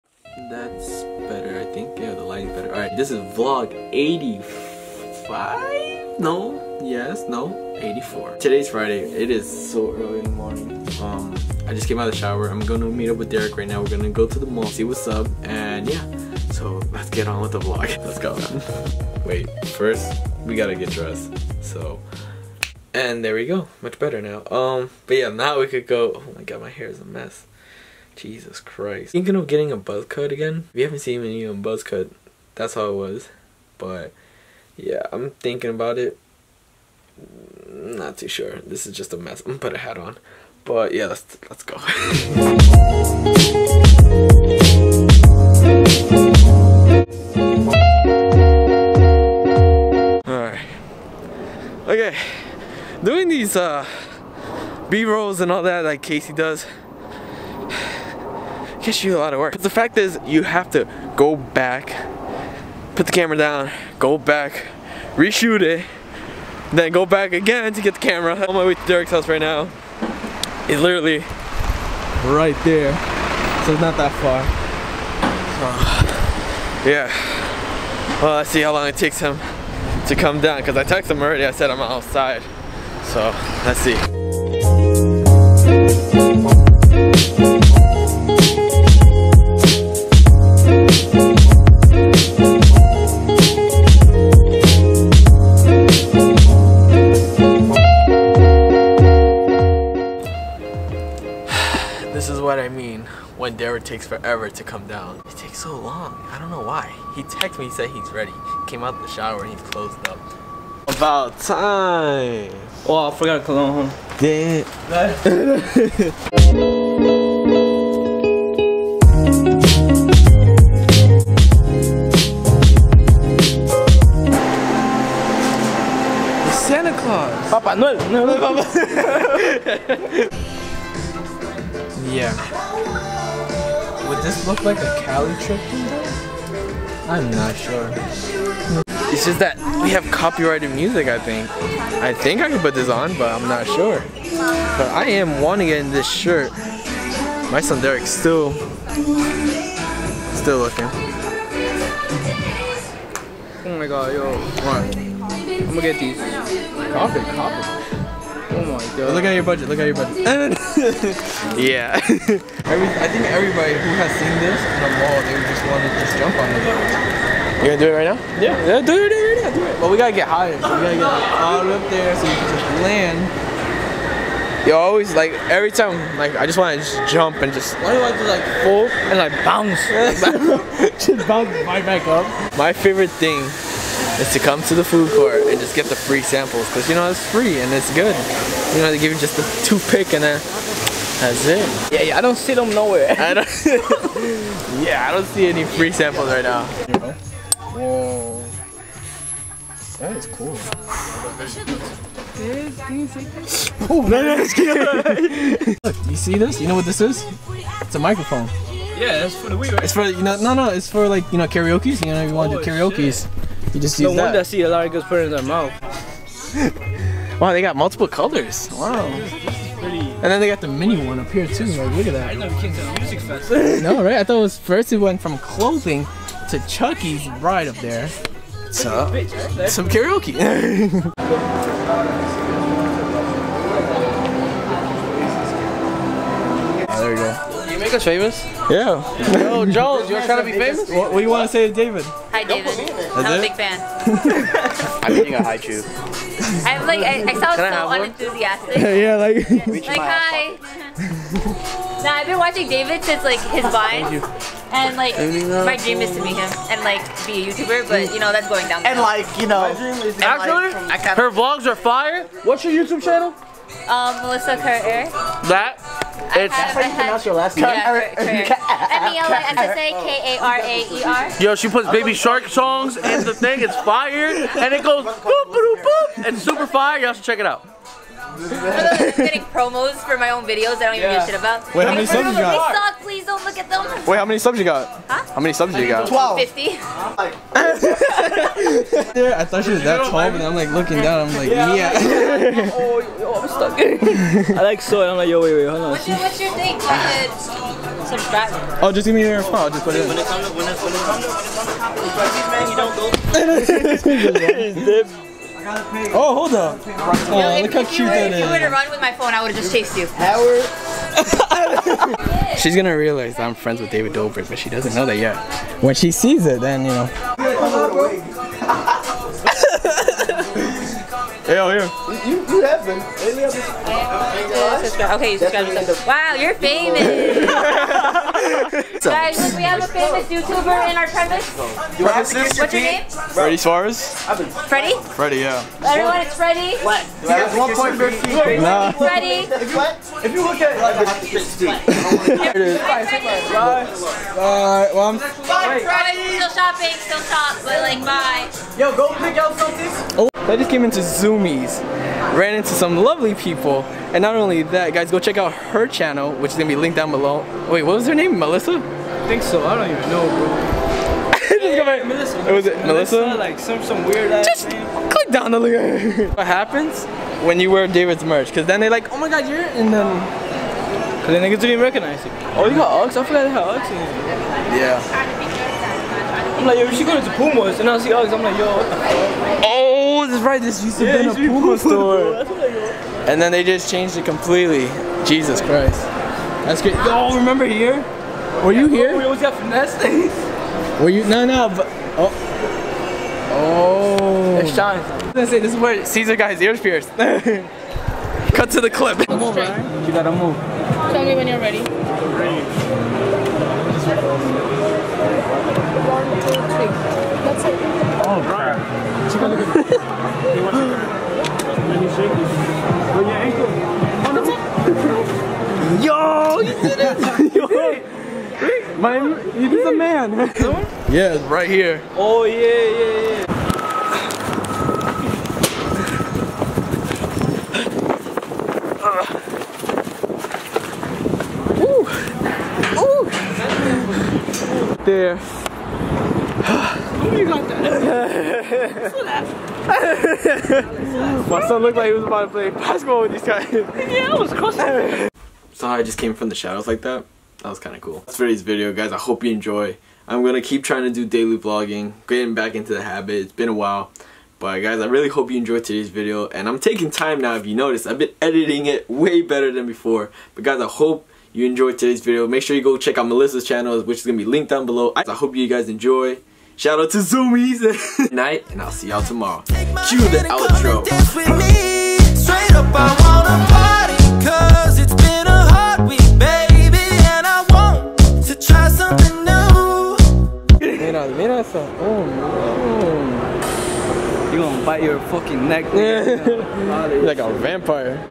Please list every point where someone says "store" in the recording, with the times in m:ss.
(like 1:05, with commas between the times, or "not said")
6:21.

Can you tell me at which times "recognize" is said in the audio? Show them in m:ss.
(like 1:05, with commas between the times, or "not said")
6:11.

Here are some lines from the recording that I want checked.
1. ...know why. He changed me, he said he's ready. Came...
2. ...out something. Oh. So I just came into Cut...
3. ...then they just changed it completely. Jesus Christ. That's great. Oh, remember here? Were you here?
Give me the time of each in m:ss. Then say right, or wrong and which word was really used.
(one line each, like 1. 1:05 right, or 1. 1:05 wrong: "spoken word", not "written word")
1. 1:46 wrong: "texted", not "changed"
2. 5:49 wrong: "Zumiez", not "Cut"
3. 6:23 right.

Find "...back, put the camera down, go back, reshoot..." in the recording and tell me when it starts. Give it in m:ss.
1:01.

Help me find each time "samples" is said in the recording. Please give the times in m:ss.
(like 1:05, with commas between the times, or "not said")
3:06, 3:15.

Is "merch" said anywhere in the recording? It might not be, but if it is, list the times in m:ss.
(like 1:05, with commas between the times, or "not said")
6:08.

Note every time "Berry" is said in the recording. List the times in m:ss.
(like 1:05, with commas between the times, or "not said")
not said.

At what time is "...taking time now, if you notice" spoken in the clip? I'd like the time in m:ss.
7:36.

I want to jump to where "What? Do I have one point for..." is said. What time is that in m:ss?
5:36.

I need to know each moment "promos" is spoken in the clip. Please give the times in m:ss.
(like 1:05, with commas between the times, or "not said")
4:39.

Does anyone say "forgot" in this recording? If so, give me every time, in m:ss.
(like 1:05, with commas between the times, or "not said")
1:53, 6:13.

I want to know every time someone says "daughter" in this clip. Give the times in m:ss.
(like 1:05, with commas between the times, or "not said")
not said.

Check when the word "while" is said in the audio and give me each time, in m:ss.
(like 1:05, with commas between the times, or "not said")
7:33.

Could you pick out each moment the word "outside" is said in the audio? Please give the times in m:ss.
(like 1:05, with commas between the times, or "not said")
1:21.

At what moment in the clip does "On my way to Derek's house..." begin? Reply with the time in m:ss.
1:08.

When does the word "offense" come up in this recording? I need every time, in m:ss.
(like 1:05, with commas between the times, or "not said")
not said.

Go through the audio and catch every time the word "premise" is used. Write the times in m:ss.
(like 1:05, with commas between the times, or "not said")
5:31.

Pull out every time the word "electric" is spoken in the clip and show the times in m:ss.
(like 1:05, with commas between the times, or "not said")
not said.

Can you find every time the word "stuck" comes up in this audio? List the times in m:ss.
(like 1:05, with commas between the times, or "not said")
4:53.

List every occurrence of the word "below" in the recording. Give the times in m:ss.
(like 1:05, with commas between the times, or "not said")
5:57, 7:44.